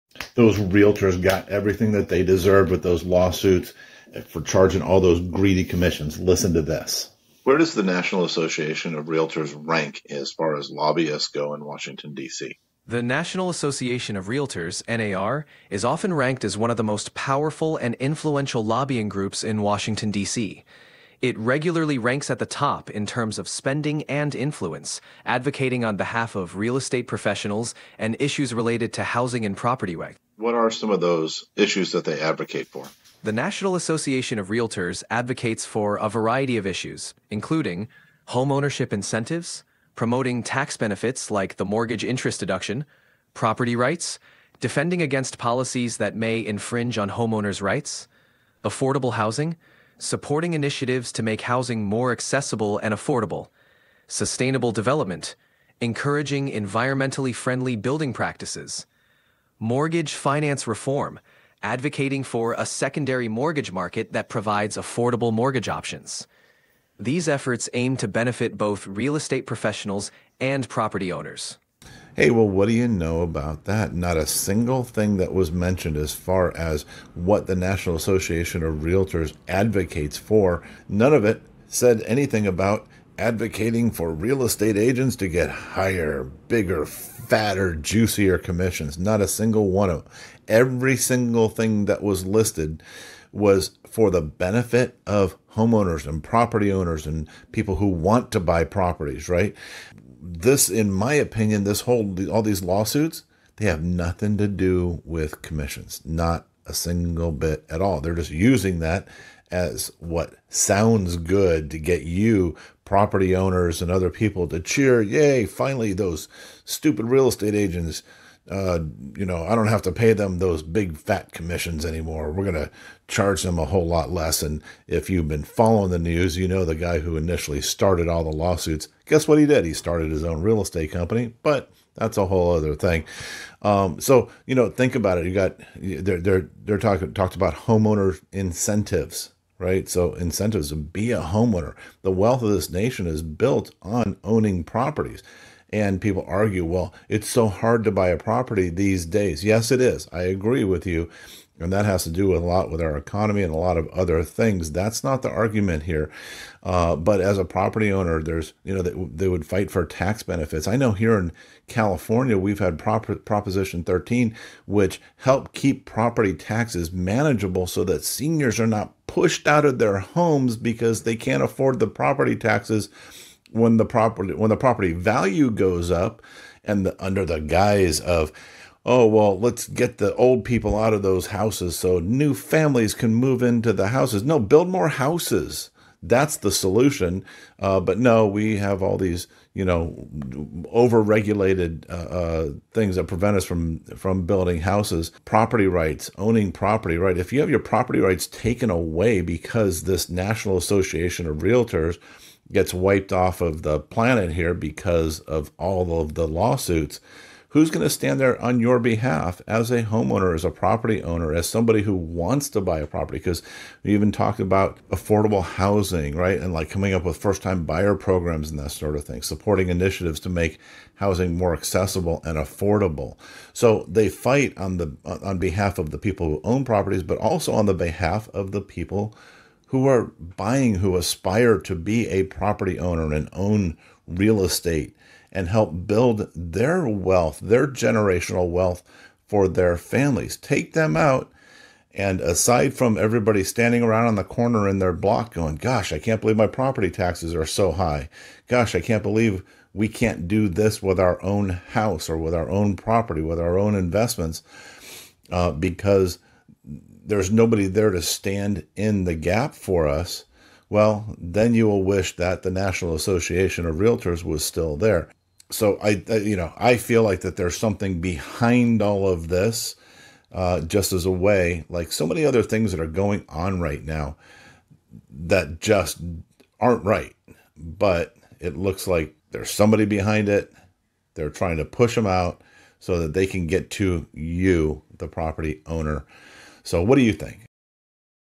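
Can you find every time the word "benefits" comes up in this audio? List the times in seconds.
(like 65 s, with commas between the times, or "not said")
40 s, 68 s, 94 s, 160 s.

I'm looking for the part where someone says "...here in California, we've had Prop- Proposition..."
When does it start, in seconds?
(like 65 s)
160 s.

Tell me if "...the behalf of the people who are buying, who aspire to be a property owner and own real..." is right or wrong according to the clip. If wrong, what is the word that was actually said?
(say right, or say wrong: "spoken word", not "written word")
right.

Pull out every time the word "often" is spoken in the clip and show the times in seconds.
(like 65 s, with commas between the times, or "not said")
15 s.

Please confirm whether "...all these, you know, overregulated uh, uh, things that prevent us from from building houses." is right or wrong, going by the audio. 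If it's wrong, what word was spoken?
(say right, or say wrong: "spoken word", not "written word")
right.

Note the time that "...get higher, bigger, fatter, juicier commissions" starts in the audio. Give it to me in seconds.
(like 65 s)
85 s.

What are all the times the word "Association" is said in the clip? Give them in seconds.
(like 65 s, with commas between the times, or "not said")
8 s, 13 s, 33 s, 77 s, 200 s, 262 s.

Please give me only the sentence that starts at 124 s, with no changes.
And if you've been following the news, you know the guy who initially started all the lawsuits.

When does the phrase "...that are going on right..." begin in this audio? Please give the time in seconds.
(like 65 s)
272 s.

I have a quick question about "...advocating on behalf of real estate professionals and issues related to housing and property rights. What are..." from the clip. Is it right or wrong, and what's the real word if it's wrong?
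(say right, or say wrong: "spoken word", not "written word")
right.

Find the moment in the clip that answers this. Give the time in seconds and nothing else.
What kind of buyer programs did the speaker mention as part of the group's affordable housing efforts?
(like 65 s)
217 s.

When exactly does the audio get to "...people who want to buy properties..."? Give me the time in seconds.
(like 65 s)
97 s.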